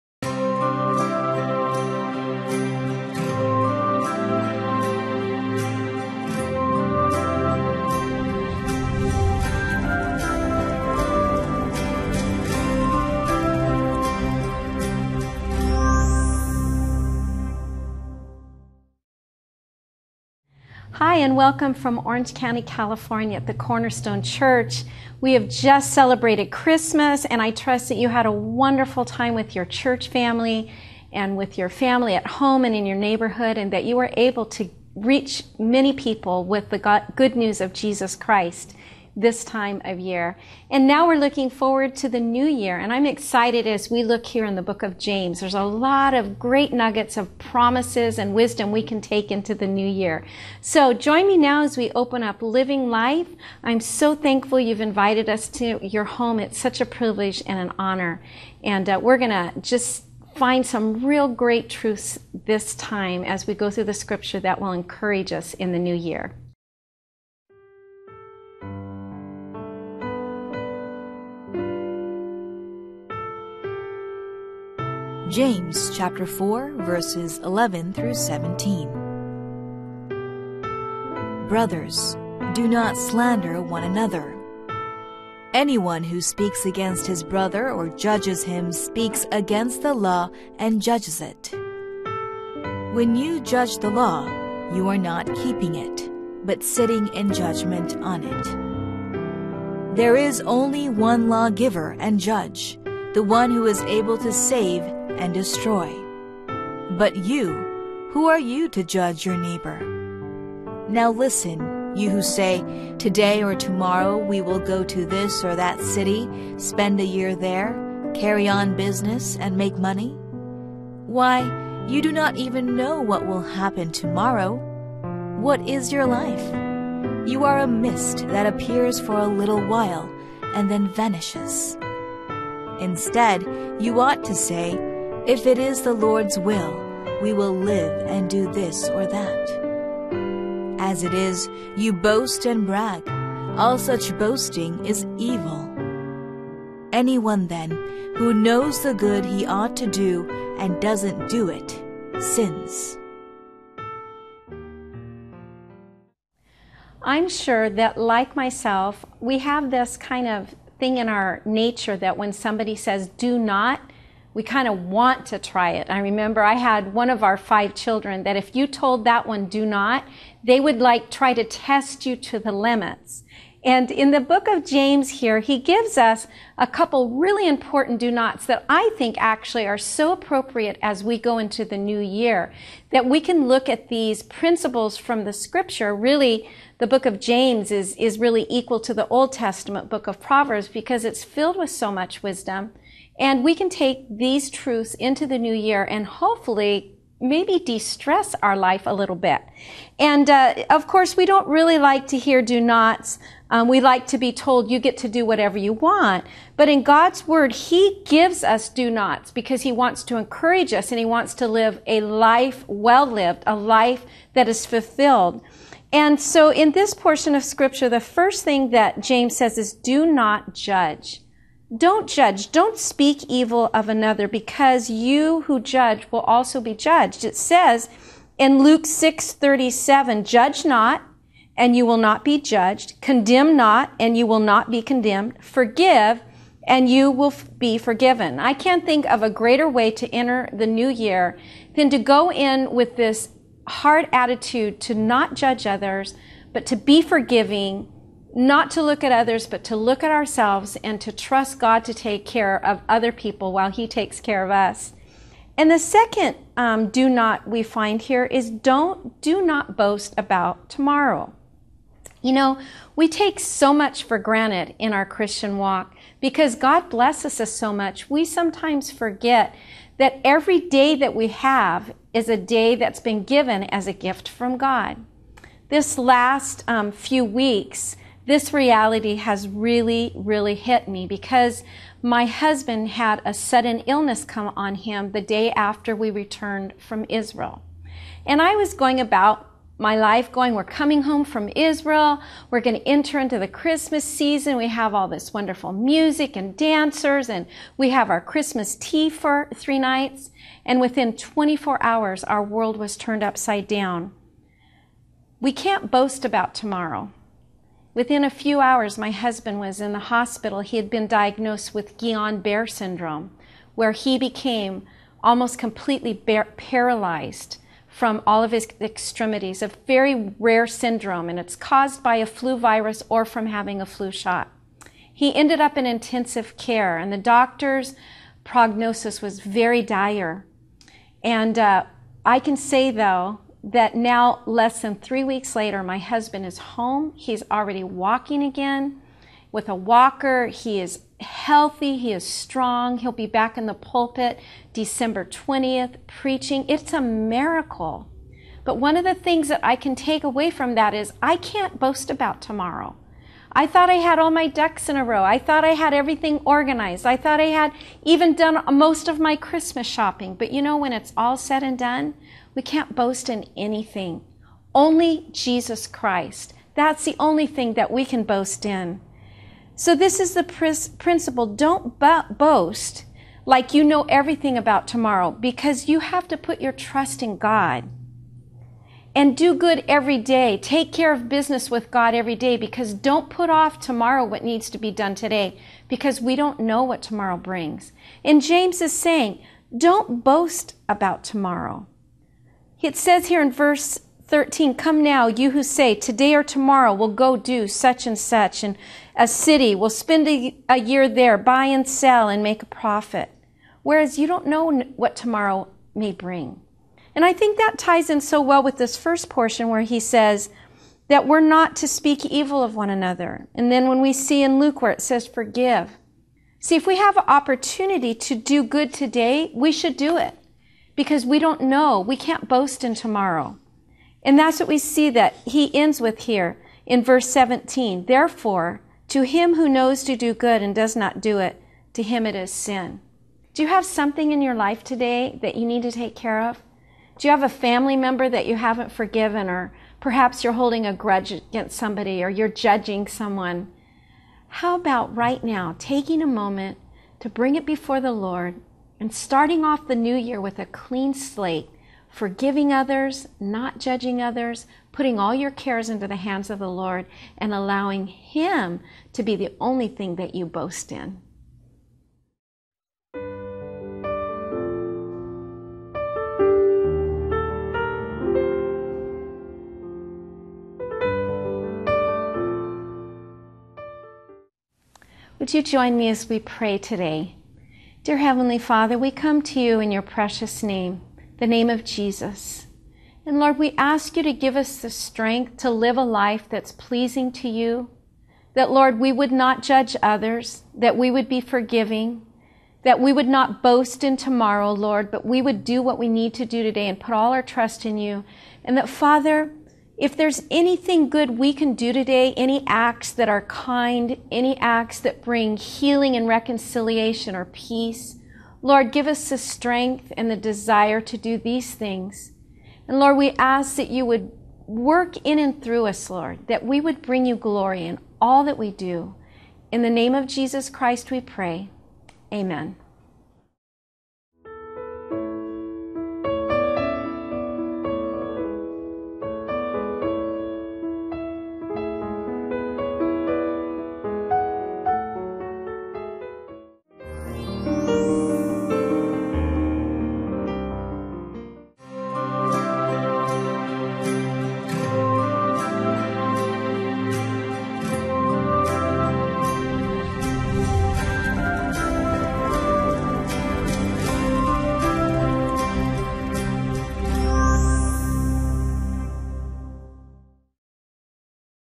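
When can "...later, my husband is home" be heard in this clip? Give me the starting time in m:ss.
5:35.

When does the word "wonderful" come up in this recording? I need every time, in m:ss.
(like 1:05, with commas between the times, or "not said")
0:28, 4:55.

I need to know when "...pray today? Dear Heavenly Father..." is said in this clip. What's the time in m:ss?
7:56.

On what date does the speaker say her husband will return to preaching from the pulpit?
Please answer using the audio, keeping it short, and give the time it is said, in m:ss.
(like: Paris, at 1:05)
December 20, at 5:44.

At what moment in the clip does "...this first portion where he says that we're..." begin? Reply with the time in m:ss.
6:48.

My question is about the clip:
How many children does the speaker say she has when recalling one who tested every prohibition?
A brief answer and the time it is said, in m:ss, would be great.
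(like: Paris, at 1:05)
5, at 2:47.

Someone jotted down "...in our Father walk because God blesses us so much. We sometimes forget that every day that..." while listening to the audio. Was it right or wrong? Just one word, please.
wrong.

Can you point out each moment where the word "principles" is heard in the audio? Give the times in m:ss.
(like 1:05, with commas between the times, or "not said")
3:04, 6:11.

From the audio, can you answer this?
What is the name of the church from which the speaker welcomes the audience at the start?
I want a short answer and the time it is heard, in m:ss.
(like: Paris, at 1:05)
Cornerstone Church, at 0:23.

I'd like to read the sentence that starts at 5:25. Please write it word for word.
He ended up in intensive care, and the doctor's prognosis was very dire.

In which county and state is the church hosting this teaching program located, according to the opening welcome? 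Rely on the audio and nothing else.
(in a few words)
Orange County, California.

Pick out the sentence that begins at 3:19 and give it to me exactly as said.
And uh, of course, we don't really like to hear do nots.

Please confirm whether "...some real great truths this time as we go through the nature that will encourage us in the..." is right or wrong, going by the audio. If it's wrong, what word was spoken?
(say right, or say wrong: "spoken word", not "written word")
wrong: "scripture", not "nature".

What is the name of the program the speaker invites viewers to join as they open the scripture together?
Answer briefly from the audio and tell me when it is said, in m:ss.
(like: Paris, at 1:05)
Living Life, at 0:52.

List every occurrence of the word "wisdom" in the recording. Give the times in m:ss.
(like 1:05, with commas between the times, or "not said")
0:48, 3:12.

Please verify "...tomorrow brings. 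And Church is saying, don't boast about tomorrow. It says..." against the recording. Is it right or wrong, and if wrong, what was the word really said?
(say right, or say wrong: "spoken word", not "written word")
wrong: "James", not "Church".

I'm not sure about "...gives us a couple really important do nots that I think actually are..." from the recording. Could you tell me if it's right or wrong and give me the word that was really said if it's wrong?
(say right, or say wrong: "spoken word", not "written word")
right.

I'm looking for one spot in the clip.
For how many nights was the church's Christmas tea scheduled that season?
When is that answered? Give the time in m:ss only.
4:59.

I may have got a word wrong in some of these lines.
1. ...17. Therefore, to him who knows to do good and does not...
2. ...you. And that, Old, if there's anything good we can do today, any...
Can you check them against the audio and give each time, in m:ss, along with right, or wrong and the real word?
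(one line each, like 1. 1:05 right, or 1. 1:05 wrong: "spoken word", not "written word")
1. 7:07 right
2. 8:17 wrong: "Father", not "Old".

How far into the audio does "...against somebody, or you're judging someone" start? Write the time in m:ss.
7:21.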